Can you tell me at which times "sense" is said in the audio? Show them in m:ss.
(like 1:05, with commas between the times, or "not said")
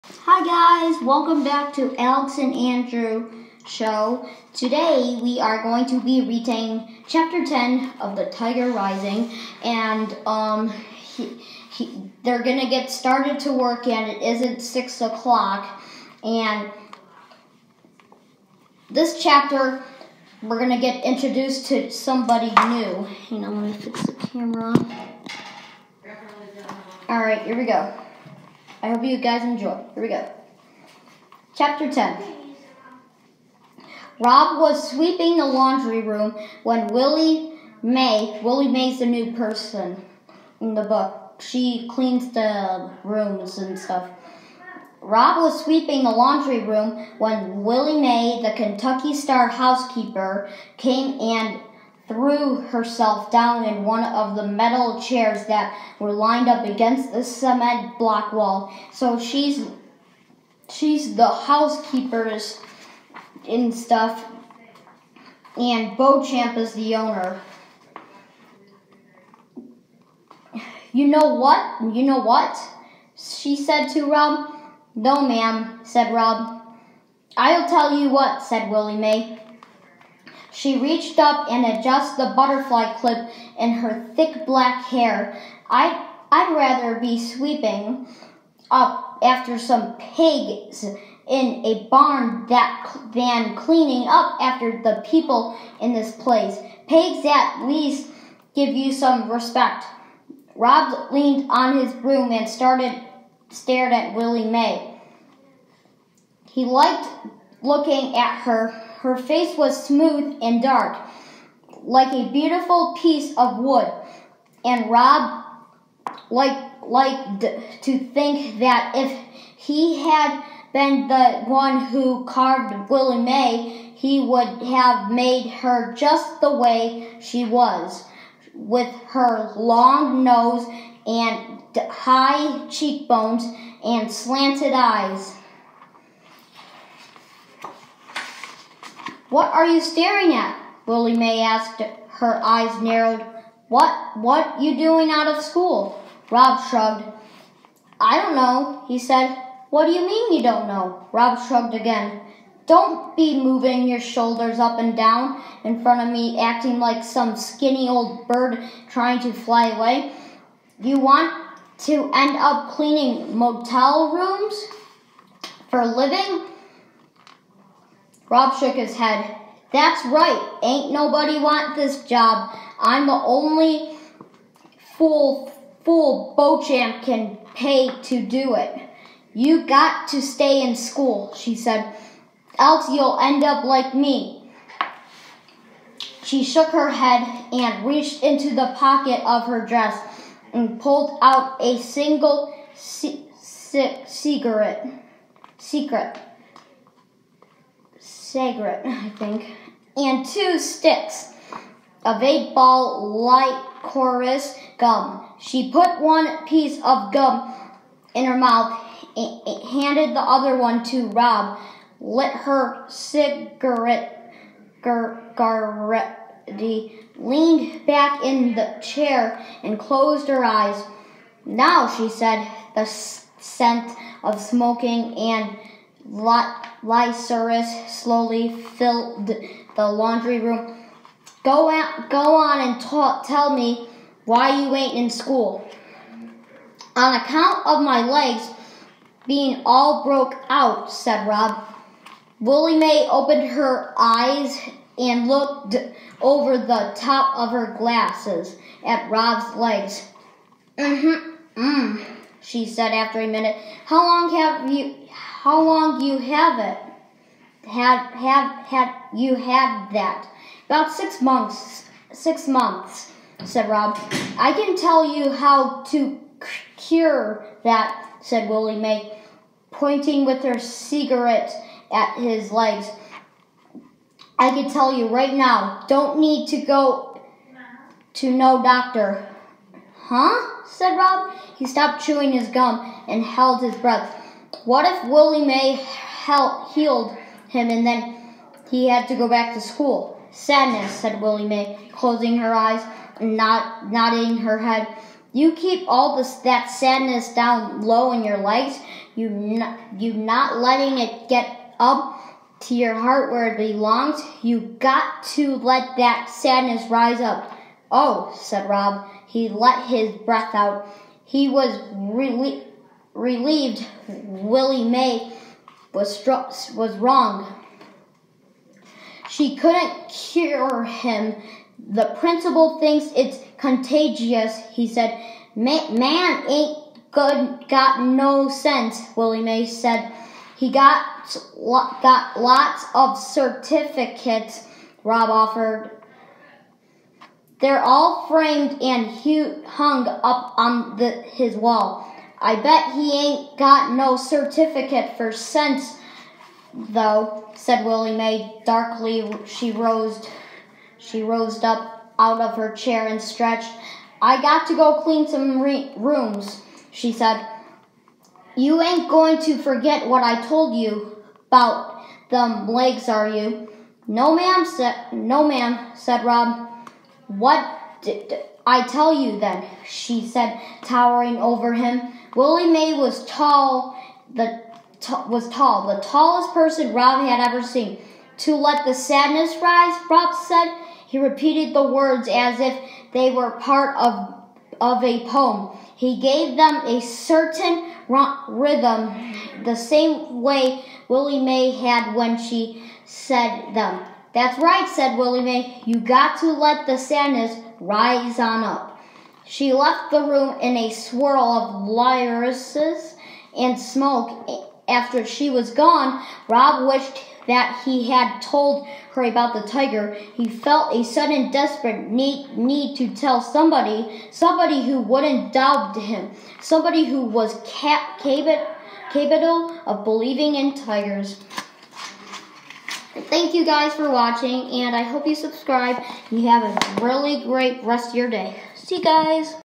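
5:28, 5:45.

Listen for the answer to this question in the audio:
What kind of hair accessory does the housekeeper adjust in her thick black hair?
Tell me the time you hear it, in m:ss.
1:22.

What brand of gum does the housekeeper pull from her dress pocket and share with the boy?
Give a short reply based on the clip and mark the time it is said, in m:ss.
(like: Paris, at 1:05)
Eight ball, at 3:22.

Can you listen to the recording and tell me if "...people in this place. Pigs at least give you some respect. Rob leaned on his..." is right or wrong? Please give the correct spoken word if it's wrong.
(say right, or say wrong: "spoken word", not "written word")
right.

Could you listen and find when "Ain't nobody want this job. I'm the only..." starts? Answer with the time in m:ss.
2:50.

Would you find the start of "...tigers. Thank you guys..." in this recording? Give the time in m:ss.
7:00.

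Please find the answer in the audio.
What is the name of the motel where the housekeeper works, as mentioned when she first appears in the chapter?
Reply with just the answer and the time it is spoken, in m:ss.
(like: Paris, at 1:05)
Kentucky Star, at 0:48.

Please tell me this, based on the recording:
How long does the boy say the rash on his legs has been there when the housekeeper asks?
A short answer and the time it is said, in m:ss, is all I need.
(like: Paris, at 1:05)
6 months, at 4:20.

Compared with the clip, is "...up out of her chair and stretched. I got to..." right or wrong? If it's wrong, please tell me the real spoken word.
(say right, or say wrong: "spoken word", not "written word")
right.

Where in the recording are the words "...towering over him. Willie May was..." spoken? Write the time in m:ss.
6:10.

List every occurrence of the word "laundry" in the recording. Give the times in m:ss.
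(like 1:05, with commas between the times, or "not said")
0:35, 0:46, 3:49.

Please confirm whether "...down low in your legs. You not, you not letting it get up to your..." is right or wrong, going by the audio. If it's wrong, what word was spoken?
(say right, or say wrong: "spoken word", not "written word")
right.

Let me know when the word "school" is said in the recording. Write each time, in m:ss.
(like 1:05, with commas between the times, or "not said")
2:25, 3:00, 3:55, 4:49.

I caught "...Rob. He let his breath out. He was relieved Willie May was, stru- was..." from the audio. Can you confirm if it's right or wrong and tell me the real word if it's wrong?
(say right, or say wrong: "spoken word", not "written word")
right.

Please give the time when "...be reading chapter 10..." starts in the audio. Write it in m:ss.
0:06.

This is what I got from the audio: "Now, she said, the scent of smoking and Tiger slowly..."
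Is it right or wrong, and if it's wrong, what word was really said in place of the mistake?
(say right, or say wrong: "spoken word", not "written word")
wrong: "Lysaurus", not "Tiger".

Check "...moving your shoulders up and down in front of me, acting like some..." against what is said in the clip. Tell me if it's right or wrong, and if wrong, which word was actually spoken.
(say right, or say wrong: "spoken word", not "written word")
right.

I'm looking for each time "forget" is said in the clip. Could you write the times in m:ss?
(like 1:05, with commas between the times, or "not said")
5:59.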